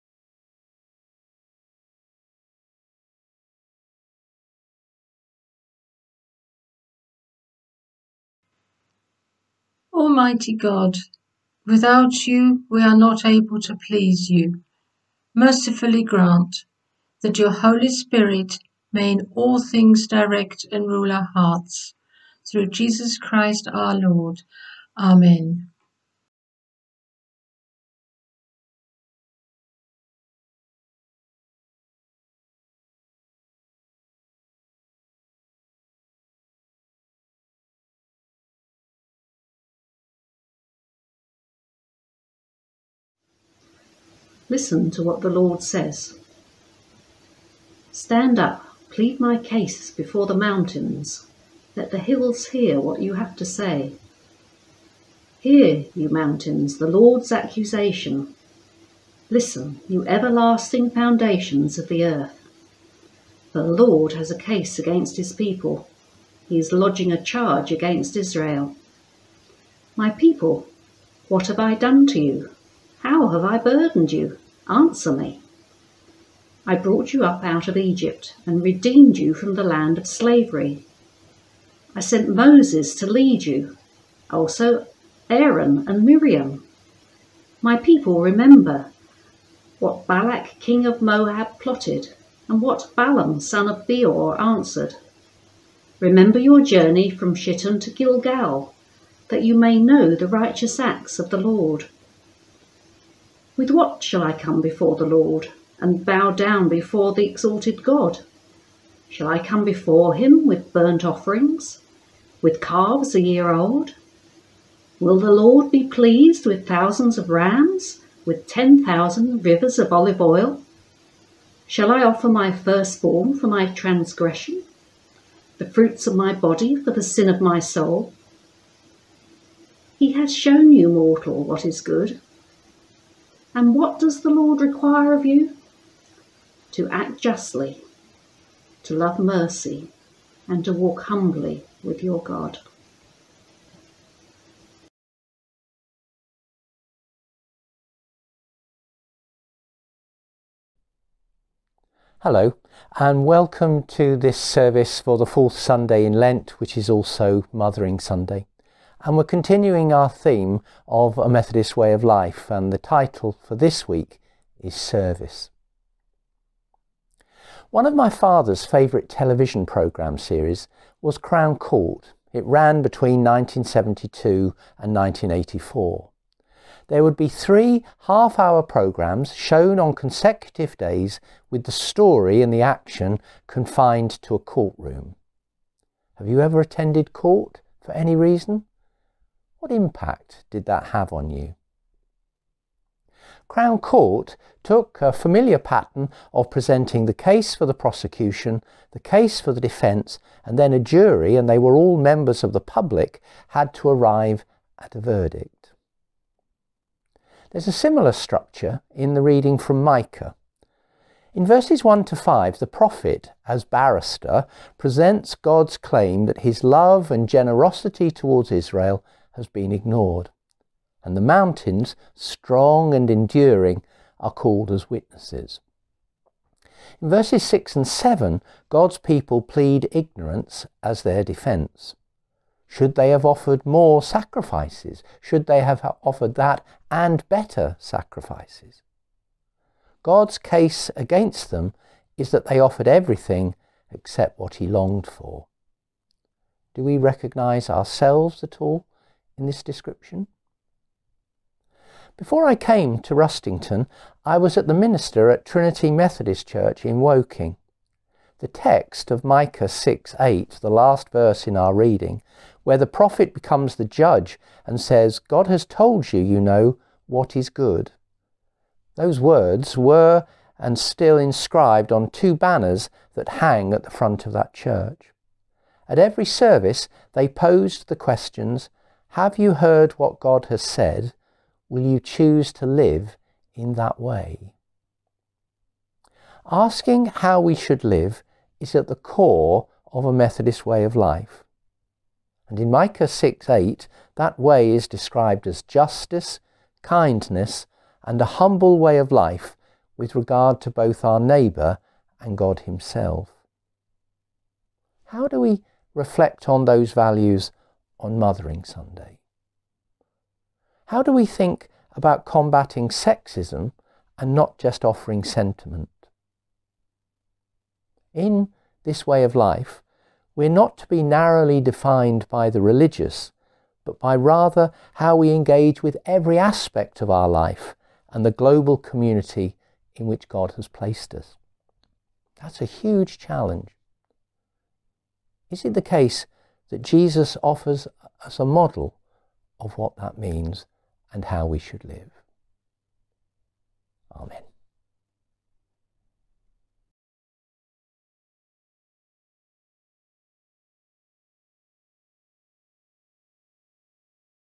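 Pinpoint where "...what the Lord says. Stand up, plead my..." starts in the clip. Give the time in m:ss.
0:45.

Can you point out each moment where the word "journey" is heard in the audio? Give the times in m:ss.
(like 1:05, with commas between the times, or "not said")
1:36.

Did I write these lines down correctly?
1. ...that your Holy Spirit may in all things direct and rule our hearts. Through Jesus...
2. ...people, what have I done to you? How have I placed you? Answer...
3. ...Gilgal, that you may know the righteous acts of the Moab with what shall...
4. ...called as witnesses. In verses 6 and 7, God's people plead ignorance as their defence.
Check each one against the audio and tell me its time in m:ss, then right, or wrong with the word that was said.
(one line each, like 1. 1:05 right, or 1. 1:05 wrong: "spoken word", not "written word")
1. 0:17 right
2. 1:10 wrong: "burdened", not "placed"
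3. 1:37 wrong: "Lord", not "Moab"
4. 3:44 right.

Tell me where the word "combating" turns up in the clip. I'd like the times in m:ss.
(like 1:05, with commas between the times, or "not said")
5:12.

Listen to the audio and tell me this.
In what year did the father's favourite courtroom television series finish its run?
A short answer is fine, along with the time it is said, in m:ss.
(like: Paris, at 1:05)
1984, at 2:54.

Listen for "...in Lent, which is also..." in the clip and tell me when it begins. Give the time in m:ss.
2:36.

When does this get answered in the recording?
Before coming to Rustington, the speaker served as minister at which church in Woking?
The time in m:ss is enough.
4:15.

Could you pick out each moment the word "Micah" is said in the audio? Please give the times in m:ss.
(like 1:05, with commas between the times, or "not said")
3:29, 4:19, 4:52.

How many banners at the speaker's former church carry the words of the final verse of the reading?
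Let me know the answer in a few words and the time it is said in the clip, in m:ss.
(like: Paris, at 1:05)
2, at 4:32.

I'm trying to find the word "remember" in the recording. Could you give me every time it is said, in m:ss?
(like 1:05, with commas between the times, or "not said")
1:28, 1:35.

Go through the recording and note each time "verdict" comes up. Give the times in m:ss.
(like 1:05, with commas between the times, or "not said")
3:24.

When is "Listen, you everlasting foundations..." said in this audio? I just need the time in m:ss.
0:59.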